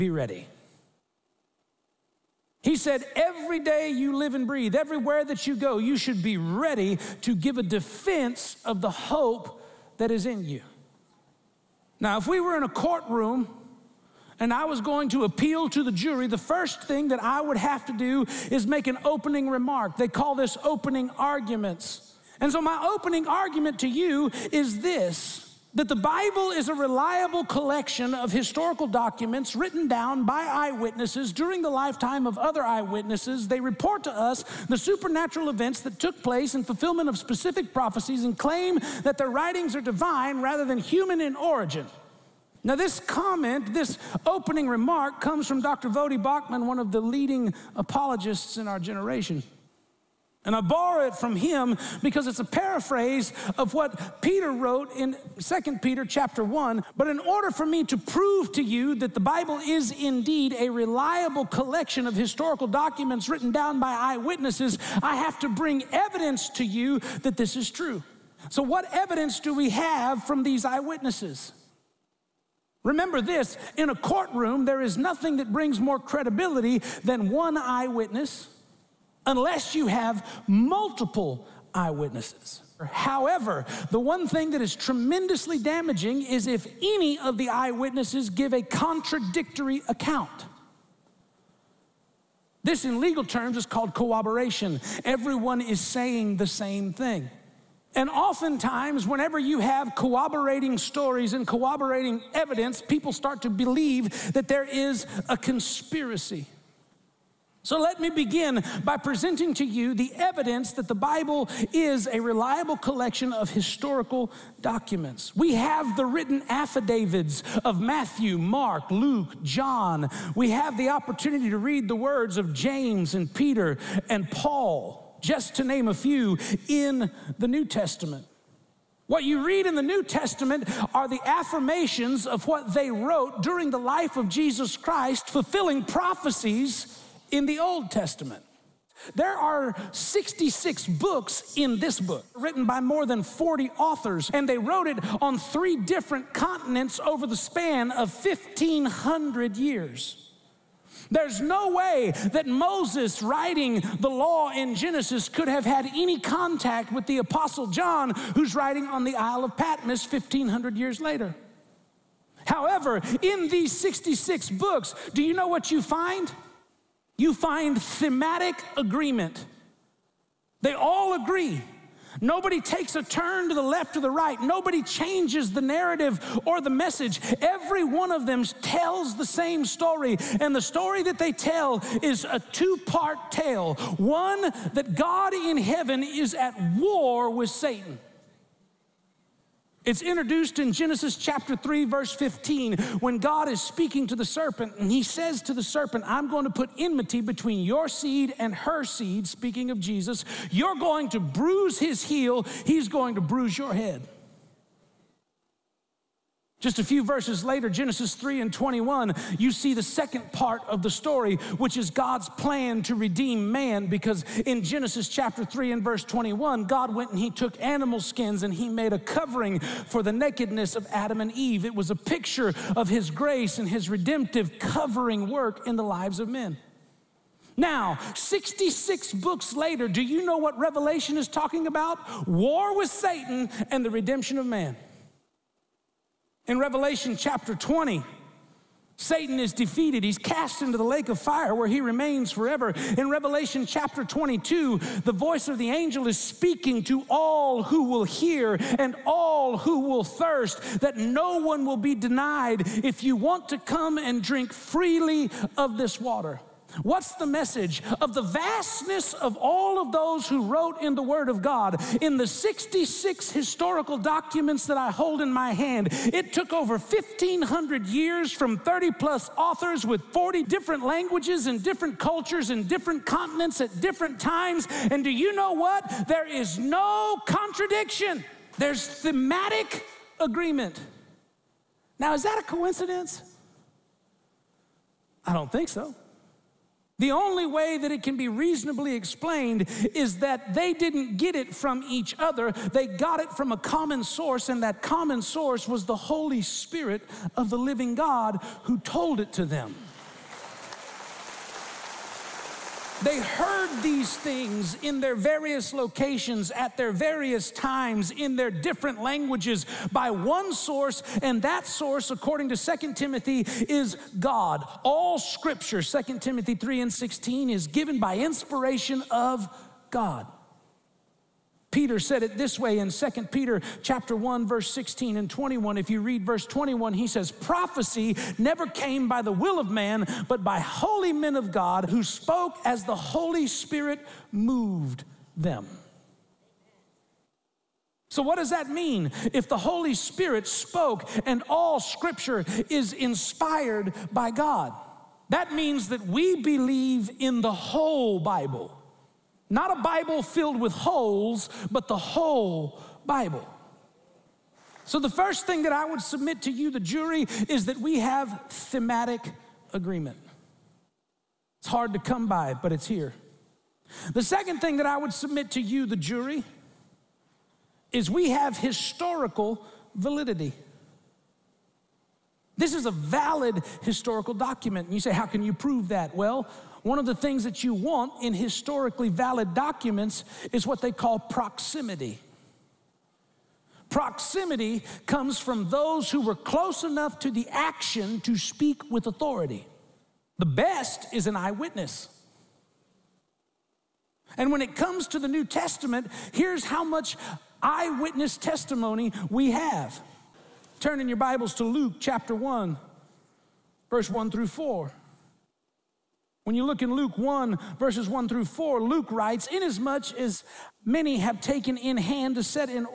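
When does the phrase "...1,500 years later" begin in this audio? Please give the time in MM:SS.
02:40.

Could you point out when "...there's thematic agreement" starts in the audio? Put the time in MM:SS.
04:38.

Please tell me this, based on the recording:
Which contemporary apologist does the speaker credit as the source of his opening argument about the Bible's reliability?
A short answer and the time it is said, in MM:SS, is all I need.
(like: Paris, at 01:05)
Voddie Baucham, at 00:45.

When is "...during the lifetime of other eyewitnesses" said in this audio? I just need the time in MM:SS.
00:31.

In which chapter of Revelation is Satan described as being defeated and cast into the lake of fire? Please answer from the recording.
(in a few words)
chapter 20.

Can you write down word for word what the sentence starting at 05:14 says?
All scripture, Second Timothy 3 and 16, is given by inspiration of God.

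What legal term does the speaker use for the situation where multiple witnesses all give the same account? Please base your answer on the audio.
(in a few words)
corroboration.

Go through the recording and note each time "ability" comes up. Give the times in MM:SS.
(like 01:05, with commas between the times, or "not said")
not said.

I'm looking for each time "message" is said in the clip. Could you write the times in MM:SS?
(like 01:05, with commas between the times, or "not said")
02:56, 04:17.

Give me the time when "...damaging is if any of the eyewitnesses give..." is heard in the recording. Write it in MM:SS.
01:25.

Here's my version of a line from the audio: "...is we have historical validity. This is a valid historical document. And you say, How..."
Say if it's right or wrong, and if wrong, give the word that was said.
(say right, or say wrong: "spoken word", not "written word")
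right.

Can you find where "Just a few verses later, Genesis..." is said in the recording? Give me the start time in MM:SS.
03:26.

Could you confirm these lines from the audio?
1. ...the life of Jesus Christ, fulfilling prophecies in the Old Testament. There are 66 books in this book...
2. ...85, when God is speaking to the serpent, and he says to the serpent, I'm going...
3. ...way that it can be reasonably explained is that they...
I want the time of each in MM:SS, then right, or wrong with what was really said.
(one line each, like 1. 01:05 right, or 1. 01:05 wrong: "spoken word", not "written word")
1. 02:13 right
2. 03:12 wrong: "15", not "85"
3. 04:47 right.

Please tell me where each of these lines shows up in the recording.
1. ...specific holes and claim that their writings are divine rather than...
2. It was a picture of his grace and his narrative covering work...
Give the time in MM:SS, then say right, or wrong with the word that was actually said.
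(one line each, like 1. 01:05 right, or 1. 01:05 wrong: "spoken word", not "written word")
1. 00:37 wrong: "prophecies", not "holes"
2. 03:41 wrong: "redemptive", not "narrative".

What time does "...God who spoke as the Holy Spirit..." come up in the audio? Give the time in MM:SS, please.
05:31.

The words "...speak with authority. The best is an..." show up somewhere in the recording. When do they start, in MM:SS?
06:28.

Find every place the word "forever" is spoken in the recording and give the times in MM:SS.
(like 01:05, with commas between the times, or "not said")
04:02.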